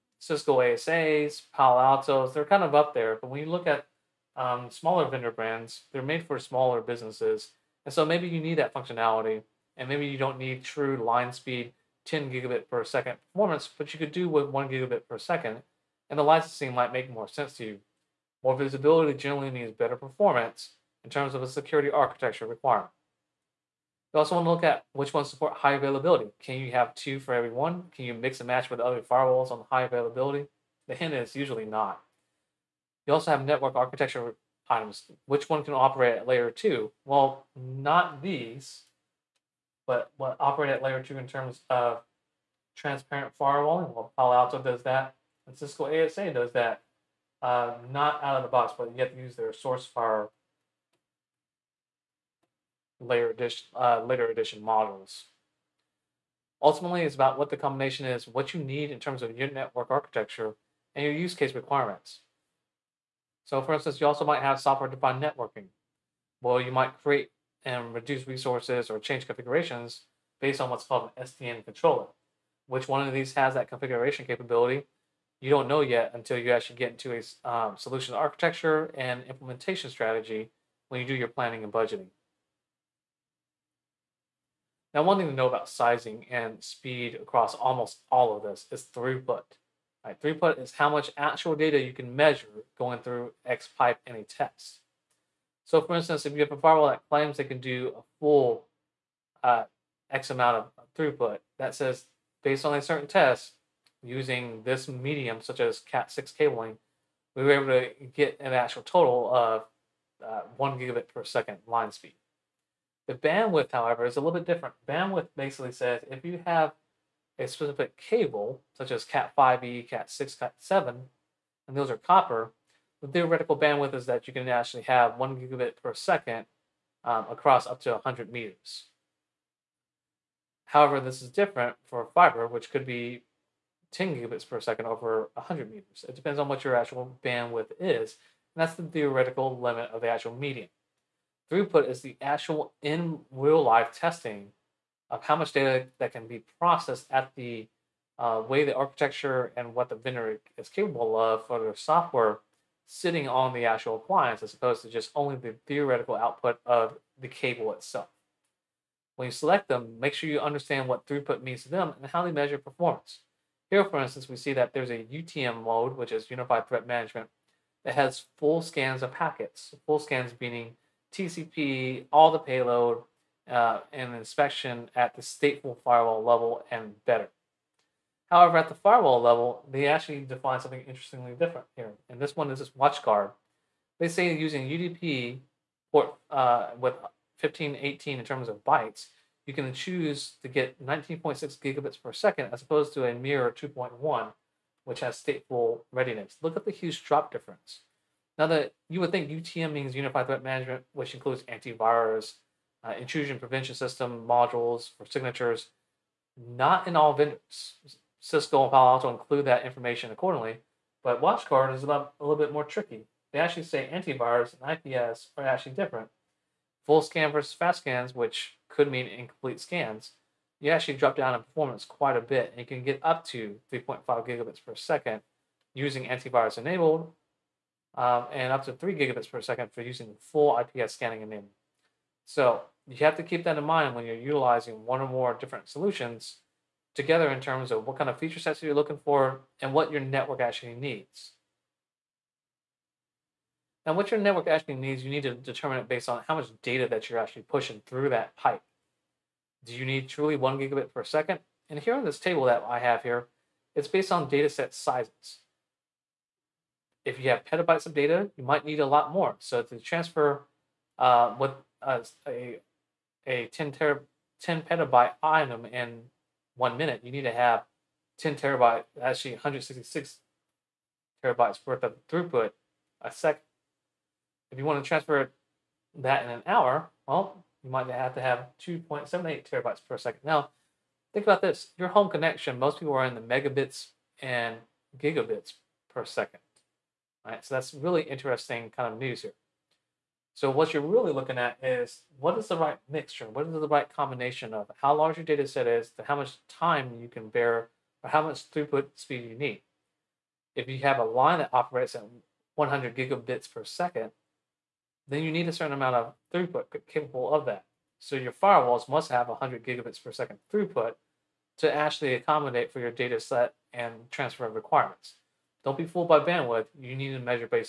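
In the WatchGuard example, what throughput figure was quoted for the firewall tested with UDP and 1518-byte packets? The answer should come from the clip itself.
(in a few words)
19.6 gigabits per second.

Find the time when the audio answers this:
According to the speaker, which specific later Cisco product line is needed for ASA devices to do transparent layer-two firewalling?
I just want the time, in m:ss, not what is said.
0:49.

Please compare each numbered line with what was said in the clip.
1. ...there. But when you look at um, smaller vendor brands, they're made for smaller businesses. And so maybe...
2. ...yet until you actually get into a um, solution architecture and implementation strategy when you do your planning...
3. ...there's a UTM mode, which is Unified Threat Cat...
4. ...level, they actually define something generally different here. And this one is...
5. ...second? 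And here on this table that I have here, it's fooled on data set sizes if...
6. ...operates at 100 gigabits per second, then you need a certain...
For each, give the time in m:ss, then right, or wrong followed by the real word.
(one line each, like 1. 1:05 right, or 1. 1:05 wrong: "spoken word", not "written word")
1. 0:02 right
2. 1:15 right
3. 2:44 wrong: "Management", not "Cat"
4. 2:59 wrong: "interestingly", not "generally"
5. 4:11 wrong: "based", not "fooled"
6. 5:01 right.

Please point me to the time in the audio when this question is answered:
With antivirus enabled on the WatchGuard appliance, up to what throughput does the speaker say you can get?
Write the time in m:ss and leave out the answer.
3:43.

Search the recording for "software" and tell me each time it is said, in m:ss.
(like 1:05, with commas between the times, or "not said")
1:04, 2:31.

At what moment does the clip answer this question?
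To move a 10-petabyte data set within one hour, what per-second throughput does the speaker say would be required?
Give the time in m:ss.
4:38.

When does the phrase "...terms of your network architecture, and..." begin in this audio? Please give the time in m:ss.
0:58.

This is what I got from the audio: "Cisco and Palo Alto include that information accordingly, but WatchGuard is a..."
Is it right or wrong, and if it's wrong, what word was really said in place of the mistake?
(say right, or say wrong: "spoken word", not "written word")
right.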